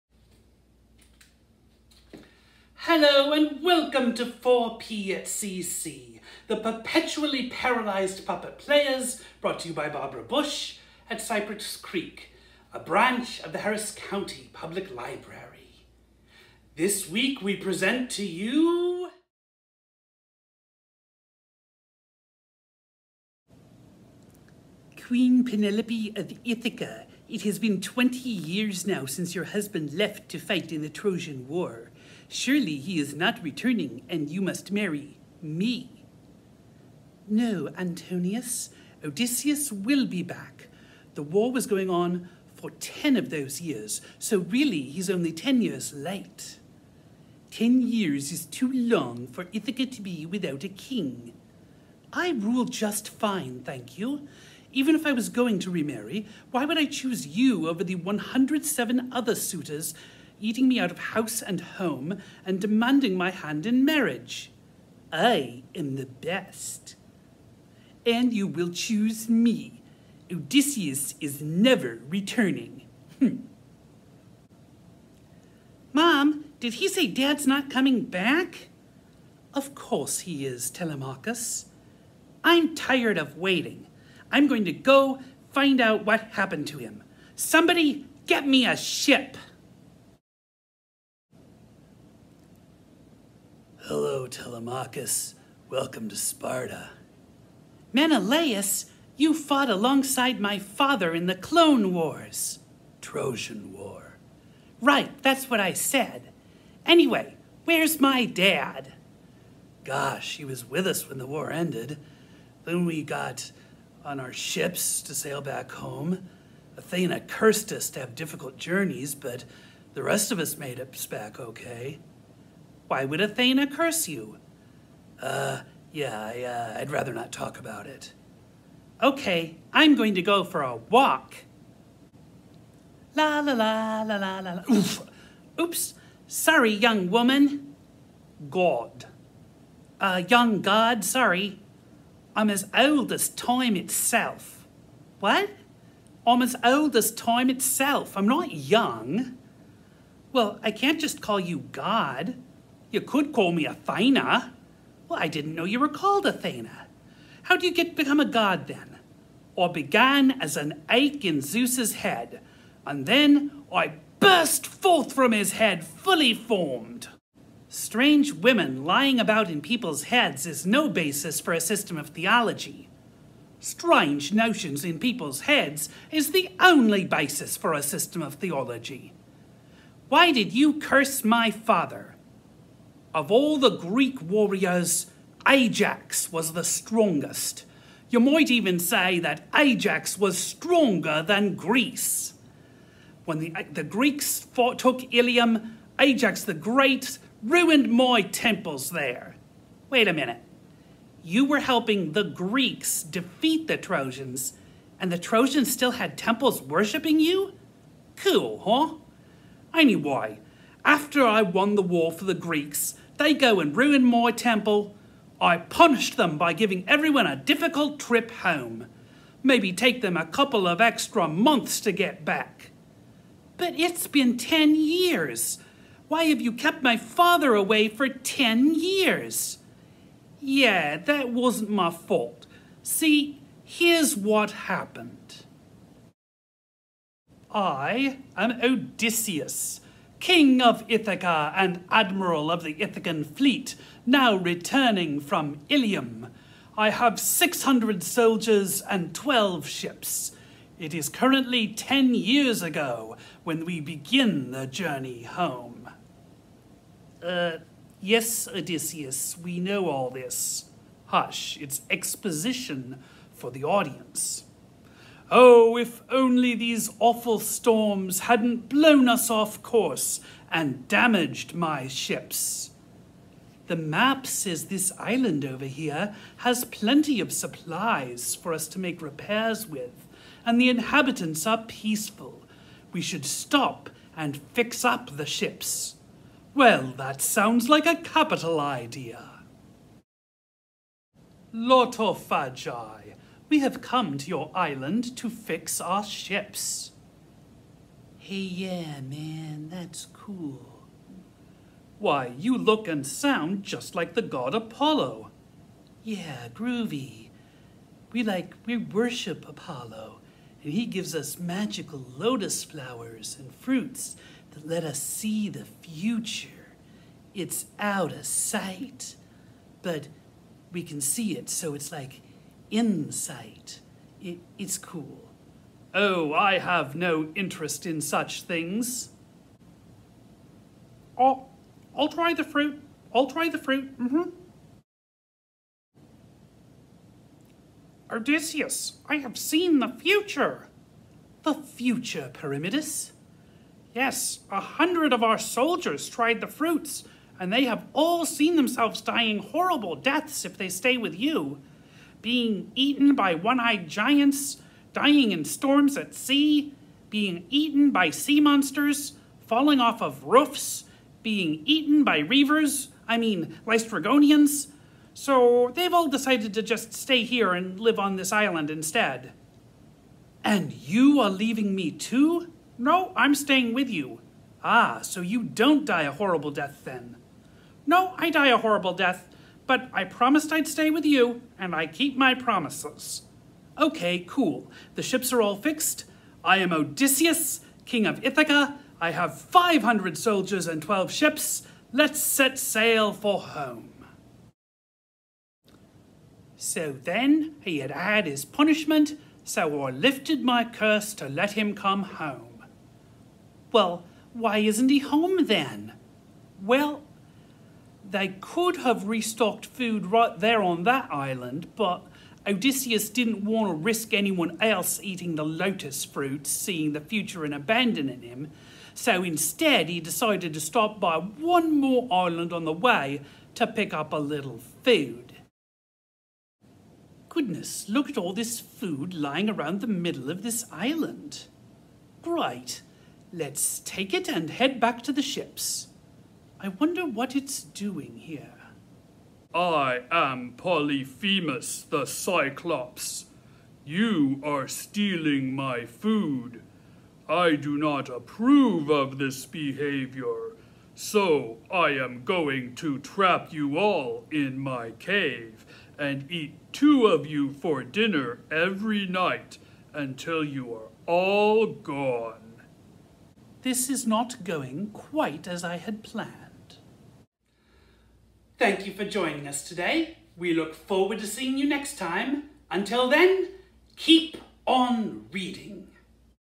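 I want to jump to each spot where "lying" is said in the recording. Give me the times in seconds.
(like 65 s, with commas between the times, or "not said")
168 s, 429 s.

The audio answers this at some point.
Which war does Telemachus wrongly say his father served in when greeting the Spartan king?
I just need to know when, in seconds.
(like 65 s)
101 s.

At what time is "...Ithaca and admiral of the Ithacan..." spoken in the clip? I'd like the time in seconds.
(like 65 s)
240 s.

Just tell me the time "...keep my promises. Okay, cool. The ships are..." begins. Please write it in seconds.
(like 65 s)
381 s.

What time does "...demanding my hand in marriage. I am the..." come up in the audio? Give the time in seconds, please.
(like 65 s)
62 s.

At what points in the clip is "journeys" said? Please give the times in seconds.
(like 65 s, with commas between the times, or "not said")
118 s, 254 s.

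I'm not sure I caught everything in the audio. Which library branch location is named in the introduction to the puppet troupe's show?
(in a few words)
Cypress Creek.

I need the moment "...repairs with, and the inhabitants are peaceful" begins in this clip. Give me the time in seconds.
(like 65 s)
279 s.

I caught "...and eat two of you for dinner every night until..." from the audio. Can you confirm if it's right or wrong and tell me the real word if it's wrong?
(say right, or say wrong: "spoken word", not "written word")
right.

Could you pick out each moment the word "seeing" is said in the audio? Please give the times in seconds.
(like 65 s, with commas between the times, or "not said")
416 s, 471 s.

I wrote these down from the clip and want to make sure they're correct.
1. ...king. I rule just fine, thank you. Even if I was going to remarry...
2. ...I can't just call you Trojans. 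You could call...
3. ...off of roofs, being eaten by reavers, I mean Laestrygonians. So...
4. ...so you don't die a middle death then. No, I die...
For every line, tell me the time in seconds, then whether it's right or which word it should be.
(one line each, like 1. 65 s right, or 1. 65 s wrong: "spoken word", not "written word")
1. 50 s right
2. 150 s wrong: "God", not "Trojans"
3. 359 s right
4. 375 s wrong: "horrible", not "middle".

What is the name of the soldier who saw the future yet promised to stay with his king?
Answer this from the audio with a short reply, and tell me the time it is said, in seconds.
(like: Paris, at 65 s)
Pyramidus, at 342 s.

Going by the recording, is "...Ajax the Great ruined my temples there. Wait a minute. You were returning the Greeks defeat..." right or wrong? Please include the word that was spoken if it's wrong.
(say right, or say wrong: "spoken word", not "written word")
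wrong: "helping", not "returning".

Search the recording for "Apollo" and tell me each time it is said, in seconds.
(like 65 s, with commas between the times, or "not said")
304 s, 309 s.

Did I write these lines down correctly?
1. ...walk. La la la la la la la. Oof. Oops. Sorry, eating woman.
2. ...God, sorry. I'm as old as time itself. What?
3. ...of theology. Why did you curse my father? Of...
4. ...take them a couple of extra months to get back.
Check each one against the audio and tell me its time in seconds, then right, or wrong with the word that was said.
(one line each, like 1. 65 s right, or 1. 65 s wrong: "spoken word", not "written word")
1. 130 s wrong: "young", not "eating"
2. 140 s right
3. 178 s right
4. 219 s right.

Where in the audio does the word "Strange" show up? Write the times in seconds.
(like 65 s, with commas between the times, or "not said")
167 s, 173 s.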